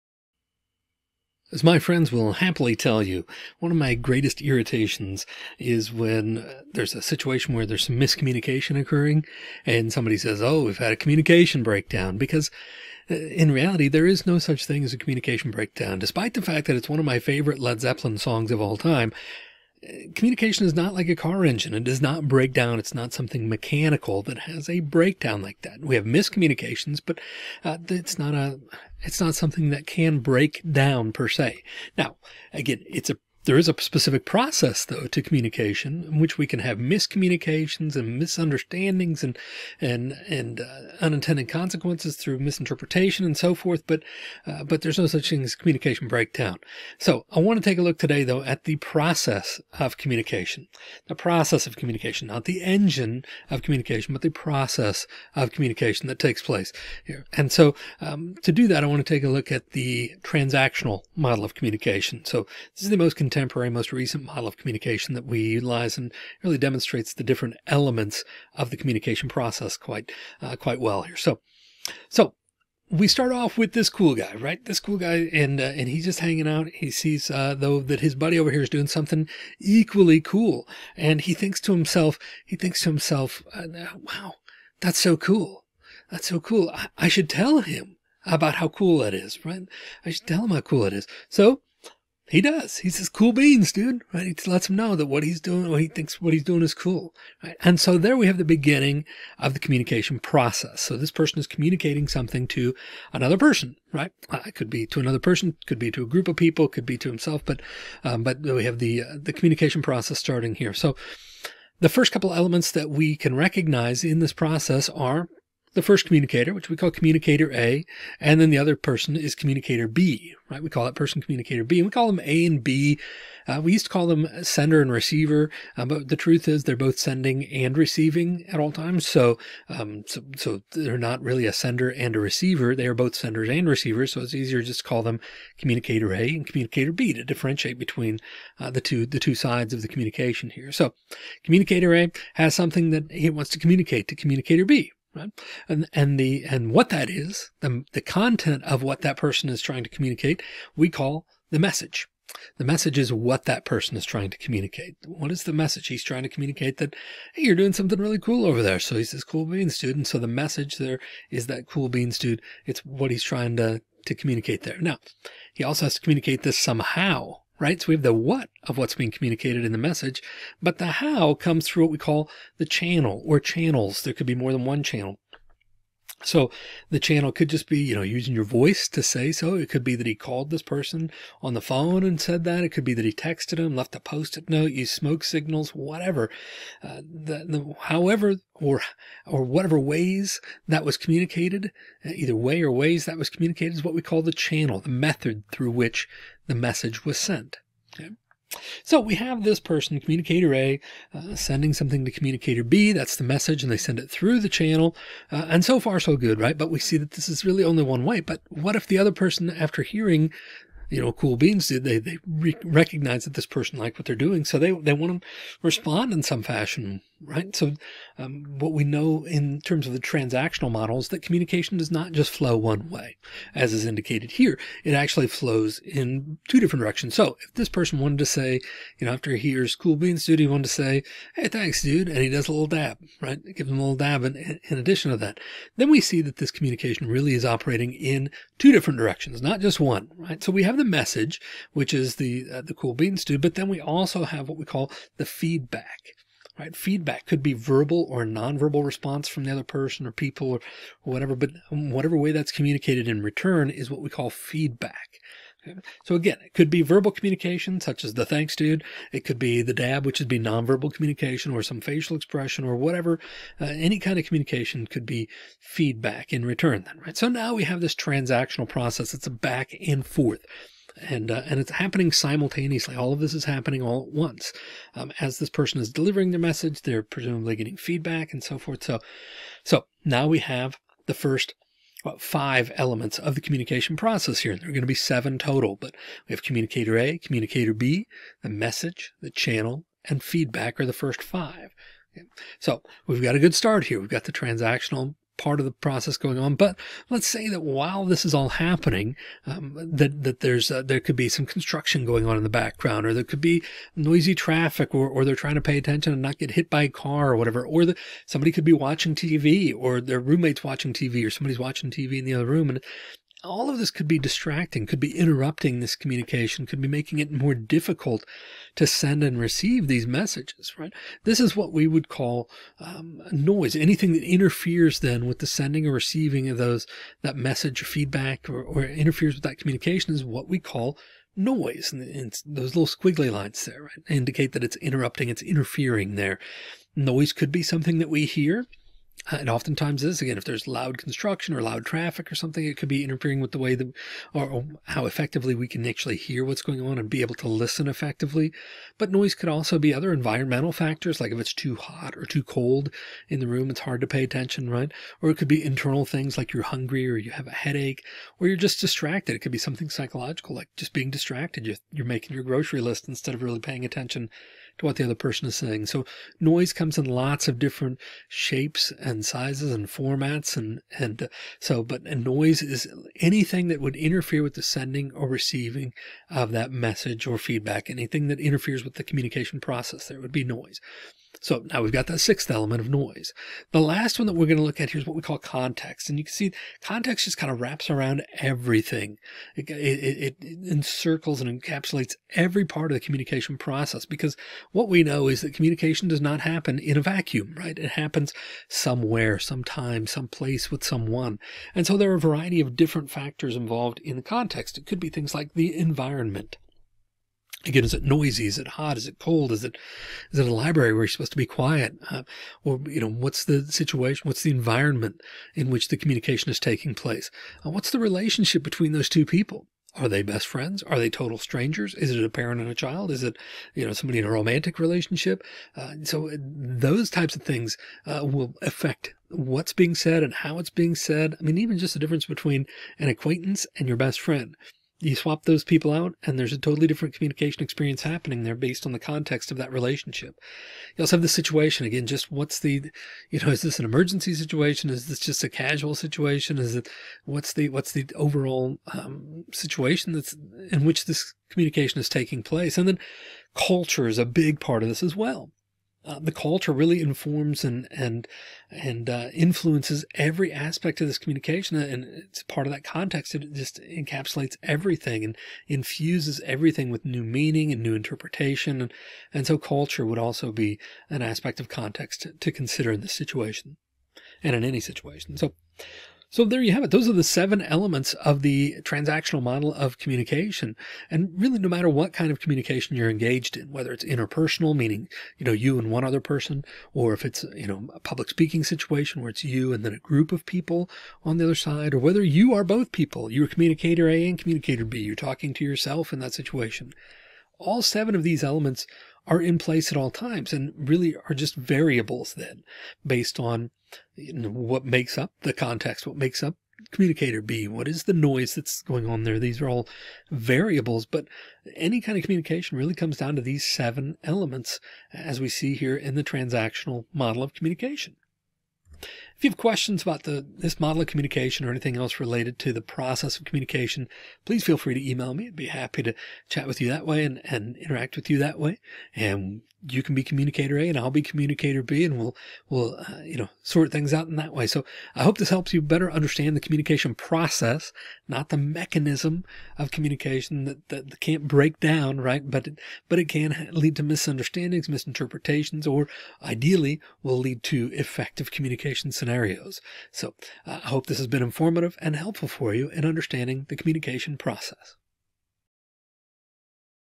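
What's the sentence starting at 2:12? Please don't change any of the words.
They are both senders and receivers.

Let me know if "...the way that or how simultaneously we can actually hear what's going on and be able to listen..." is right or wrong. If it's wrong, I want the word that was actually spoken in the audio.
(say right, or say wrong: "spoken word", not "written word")
wrong: "effectively", not "simultaneously".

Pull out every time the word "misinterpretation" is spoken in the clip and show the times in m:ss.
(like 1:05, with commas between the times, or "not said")
0:42, 9:04.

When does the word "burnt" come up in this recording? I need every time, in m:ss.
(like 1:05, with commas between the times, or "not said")
not said.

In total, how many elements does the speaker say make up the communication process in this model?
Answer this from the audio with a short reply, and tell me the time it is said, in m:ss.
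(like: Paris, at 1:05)
7, at 4:44.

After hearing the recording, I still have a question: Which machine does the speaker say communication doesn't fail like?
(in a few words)
car engine.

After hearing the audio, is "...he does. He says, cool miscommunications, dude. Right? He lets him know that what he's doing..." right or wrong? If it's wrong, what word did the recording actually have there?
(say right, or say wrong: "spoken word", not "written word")
wrong: "beans", not "miscommunications".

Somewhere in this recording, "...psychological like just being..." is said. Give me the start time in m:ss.
5:59.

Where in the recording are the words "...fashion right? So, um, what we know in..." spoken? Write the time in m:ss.
3:36.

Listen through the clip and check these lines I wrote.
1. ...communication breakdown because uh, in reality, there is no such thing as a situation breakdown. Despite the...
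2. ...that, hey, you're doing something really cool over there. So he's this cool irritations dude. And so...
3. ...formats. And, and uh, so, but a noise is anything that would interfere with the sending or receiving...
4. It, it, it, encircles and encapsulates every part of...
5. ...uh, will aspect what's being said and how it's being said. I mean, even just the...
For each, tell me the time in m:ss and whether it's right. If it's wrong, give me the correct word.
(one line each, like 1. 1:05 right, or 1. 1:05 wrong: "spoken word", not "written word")
1. 0:10 wrong: "communication", not "situation"
2. 2:36 wrong: "beans", not "irritations"
3. 6:09 right
4. 6:29 right
5. 7:08 wrong: "affect", not "aspect".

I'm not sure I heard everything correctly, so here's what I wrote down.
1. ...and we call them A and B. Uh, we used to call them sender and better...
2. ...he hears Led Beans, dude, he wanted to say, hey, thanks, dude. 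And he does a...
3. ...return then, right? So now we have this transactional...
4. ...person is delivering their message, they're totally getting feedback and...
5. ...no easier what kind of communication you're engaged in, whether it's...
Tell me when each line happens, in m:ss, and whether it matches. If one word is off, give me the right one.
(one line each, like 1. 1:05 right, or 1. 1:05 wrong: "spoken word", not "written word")
1. 2:01 wrong: "receiver", not "better"
2. 3:49 wrong: "Cool", not "Led"
3. 4:26 right
4. 4:35 wrong: "presumably", not "totally"
5. 8:01 wrong: "matter", not "easier".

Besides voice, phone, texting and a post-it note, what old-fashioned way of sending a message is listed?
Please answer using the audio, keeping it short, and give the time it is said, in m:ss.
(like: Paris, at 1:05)
smoke signals, at 3:04.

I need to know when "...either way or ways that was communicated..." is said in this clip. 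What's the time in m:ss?
3:12.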